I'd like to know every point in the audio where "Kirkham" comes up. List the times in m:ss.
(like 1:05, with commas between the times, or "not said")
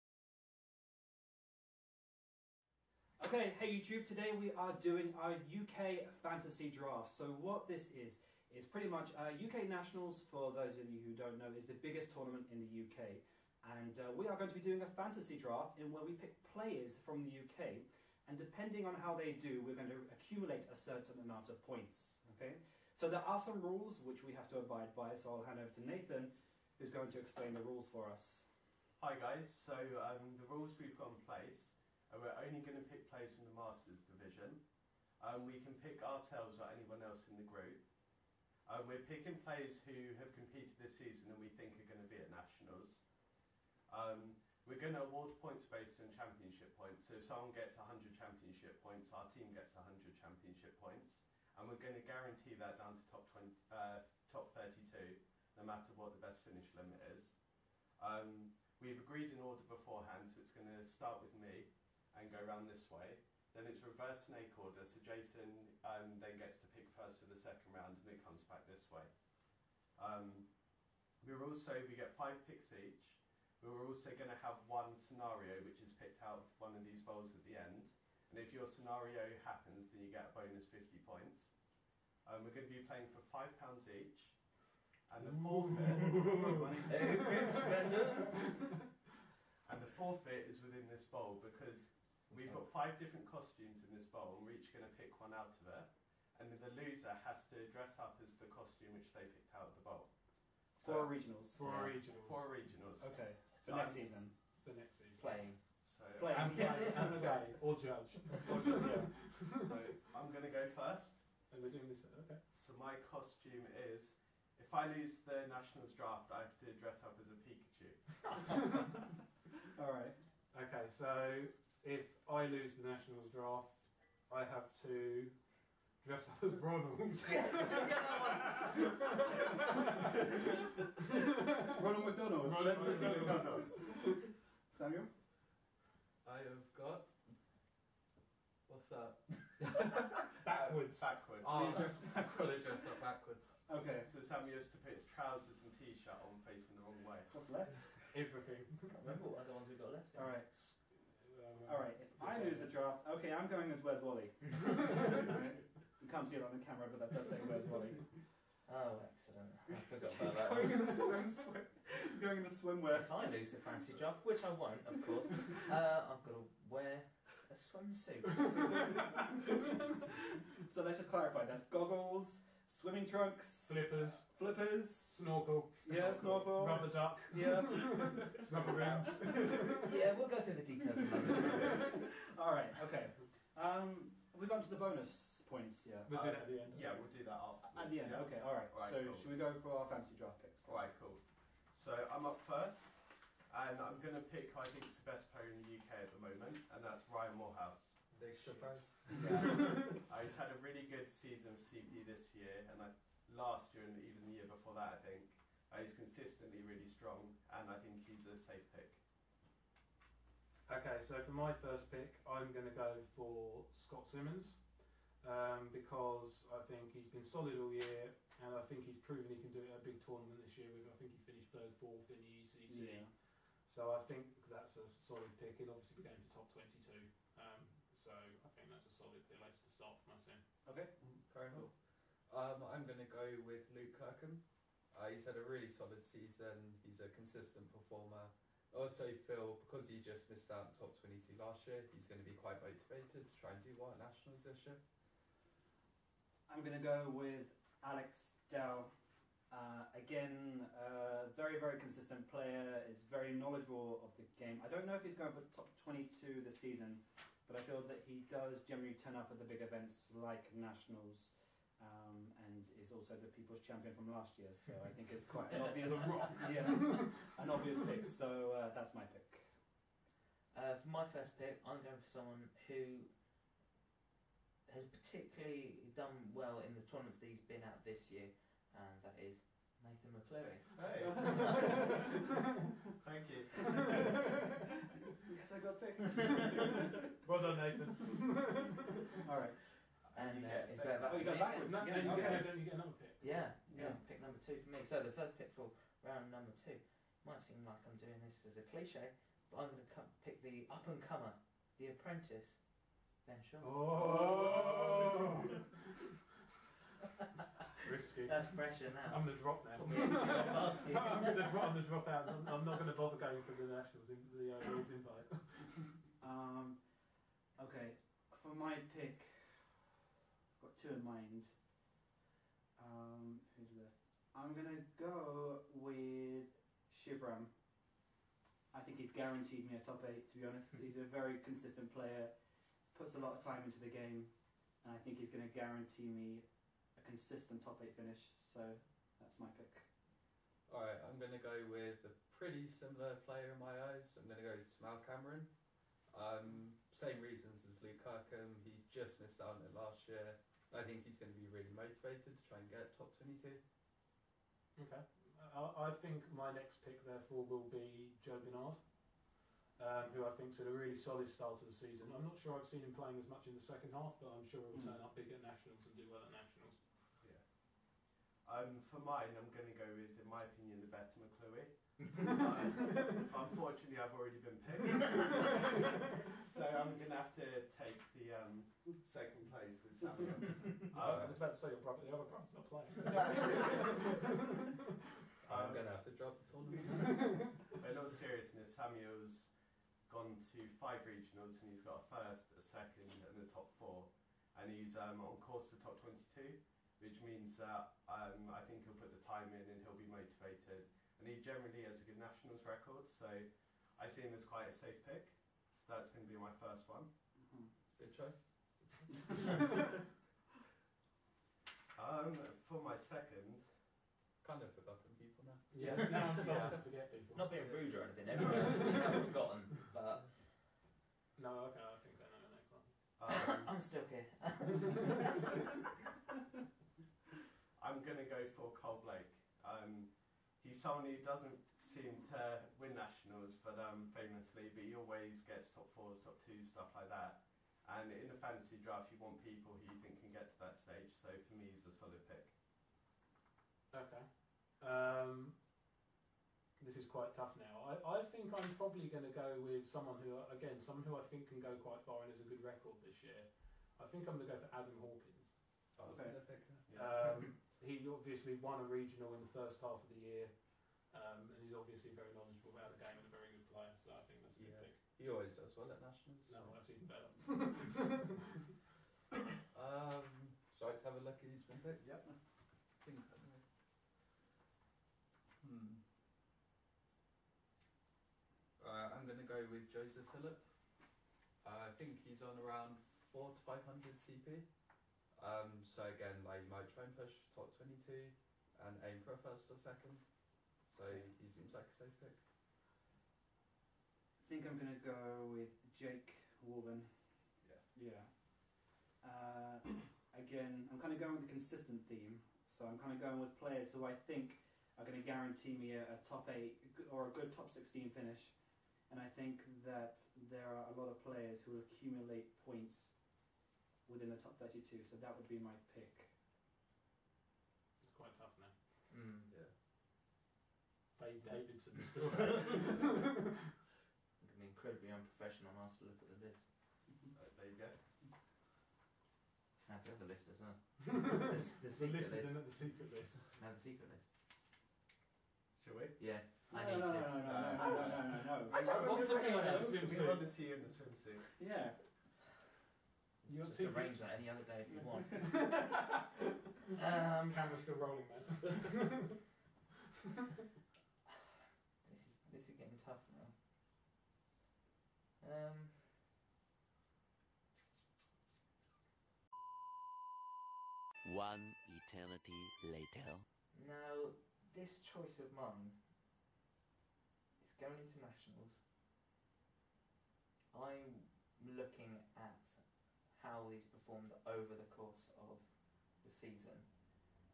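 3:53, 5:48.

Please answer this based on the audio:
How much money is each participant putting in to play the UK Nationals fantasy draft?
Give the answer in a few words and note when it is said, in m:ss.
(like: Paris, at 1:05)
£5, at 1:23.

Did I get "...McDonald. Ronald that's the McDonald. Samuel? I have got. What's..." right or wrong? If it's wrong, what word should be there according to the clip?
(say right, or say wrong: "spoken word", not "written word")
right.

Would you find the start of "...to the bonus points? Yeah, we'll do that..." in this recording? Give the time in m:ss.
3:04.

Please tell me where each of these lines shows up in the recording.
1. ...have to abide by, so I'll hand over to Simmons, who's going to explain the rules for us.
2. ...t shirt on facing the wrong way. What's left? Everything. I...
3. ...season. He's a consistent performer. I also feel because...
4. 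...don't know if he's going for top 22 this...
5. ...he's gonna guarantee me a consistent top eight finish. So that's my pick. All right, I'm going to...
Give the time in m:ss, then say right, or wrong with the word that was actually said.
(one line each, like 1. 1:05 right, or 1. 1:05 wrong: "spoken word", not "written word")
1. 0:24 wrong: "Nathan", not "Simmons"
2. 2:25 right
3. 3:56 right
4. 4:14 right
5. 5:35 right.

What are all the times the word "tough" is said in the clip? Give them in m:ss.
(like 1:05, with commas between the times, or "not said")
7:27, 8:38, 9:12.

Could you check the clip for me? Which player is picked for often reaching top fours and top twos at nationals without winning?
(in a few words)
Cole Blake.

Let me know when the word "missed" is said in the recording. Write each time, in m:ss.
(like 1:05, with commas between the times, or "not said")
4:00, 5:49.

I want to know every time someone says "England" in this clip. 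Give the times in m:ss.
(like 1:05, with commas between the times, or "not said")
not said.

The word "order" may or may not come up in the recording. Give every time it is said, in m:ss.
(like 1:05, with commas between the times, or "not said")
0:59, 1:04.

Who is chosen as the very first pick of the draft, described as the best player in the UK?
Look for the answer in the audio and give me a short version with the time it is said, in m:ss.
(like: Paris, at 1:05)
Ryan Morehouse, at 3:17.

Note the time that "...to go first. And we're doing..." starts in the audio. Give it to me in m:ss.
1:50.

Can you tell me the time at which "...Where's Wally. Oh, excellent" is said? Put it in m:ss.
2:37.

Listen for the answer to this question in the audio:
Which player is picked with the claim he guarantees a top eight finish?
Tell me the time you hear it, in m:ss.
5:26.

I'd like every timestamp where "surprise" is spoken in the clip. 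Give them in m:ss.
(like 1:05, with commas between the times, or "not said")
3:18.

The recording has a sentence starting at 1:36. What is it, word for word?
And the loser has to dress up as the costume which they picked out of the bowl.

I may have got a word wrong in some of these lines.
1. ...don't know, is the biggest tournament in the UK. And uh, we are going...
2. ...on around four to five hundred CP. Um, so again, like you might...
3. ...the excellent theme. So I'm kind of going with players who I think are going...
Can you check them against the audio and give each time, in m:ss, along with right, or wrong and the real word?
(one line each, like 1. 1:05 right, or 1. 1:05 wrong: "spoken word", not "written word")
1. 0:11 right
2. 8:02 right
3. 8:21 wrong: "consistent", not "excellent".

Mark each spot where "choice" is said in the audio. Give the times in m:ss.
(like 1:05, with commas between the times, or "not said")
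6:48, 9:25.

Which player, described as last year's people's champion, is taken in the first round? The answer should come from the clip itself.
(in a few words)
Alex Dell.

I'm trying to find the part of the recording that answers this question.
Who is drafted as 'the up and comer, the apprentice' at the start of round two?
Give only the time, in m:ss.
5:03.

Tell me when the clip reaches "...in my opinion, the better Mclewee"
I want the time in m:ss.
6:10.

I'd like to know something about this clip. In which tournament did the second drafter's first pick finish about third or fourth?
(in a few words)
ECC.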